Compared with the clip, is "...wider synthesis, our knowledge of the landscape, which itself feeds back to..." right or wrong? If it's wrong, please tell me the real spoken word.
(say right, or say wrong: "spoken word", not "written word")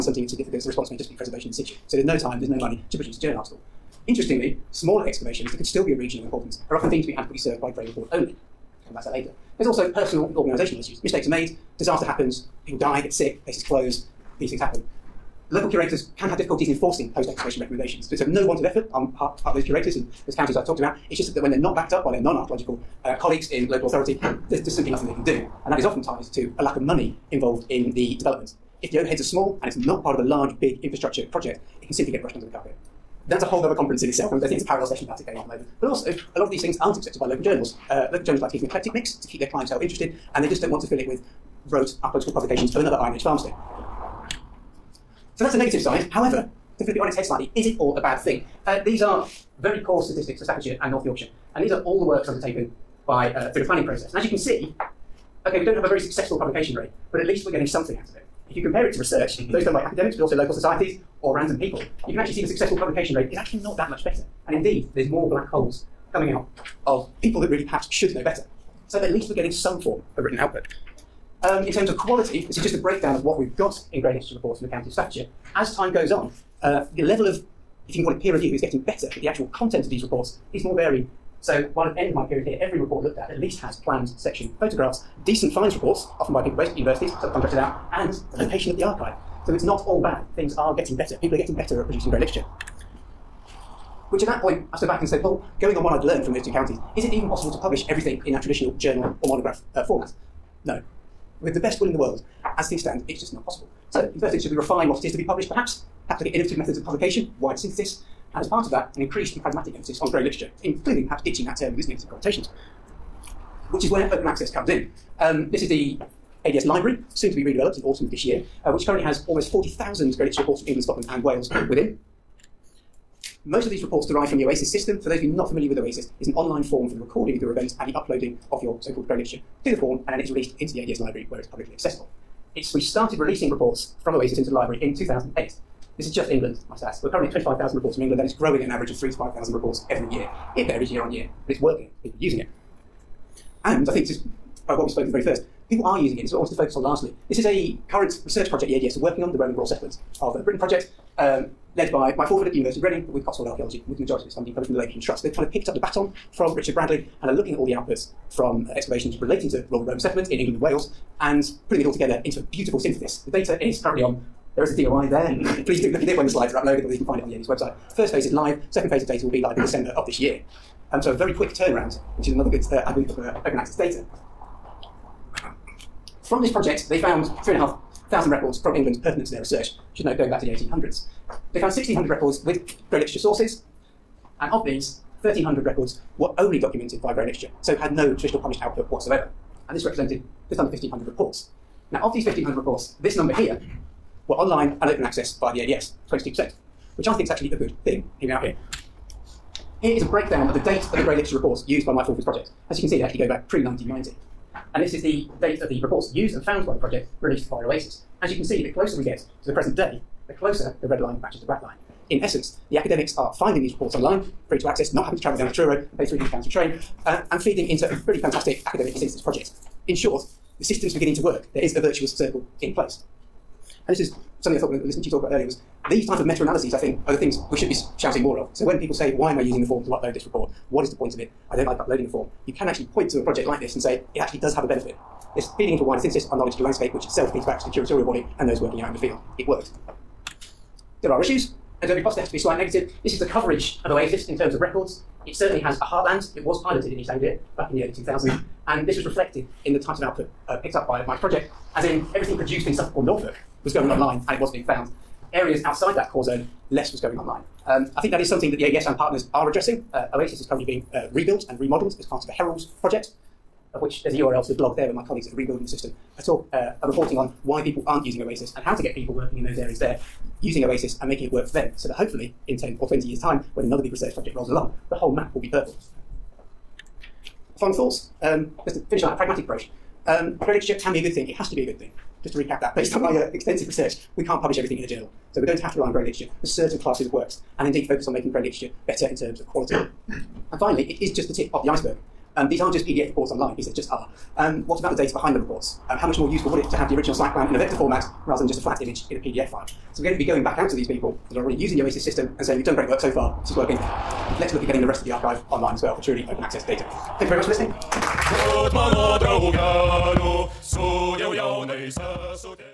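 right.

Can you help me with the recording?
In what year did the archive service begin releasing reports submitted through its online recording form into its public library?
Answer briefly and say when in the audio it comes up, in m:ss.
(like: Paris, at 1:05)
2008, at 2:14.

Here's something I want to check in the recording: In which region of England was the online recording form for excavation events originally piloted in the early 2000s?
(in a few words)
East Anglia.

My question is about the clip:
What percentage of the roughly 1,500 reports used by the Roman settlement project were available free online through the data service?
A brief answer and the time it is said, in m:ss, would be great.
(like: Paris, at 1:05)
22%, at 3:16.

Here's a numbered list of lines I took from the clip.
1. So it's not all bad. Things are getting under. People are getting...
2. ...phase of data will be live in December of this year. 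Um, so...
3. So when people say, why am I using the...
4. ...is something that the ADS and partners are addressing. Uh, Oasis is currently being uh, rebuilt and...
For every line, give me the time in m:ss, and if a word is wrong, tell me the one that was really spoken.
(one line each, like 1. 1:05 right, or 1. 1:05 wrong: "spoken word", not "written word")
1. 1:29 wrong: "better", not "under"
2. 2:48 right
3. 3:48 right
4. 4:18 right.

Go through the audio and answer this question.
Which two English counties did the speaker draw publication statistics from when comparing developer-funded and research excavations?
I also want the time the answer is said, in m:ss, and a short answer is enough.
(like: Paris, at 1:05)
Staffordshire and North Yorkshire, at 0:50.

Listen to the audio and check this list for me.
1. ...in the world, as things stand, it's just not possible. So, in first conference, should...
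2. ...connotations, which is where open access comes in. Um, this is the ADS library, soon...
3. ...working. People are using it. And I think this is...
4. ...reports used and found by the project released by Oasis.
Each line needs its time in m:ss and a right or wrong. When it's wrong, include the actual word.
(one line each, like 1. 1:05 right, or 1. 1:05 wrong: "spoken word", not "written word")
1. 1:41 wrong: "instance", not "conference"
2. 1:52 right
3. 2:21 right
4. 3:25 right.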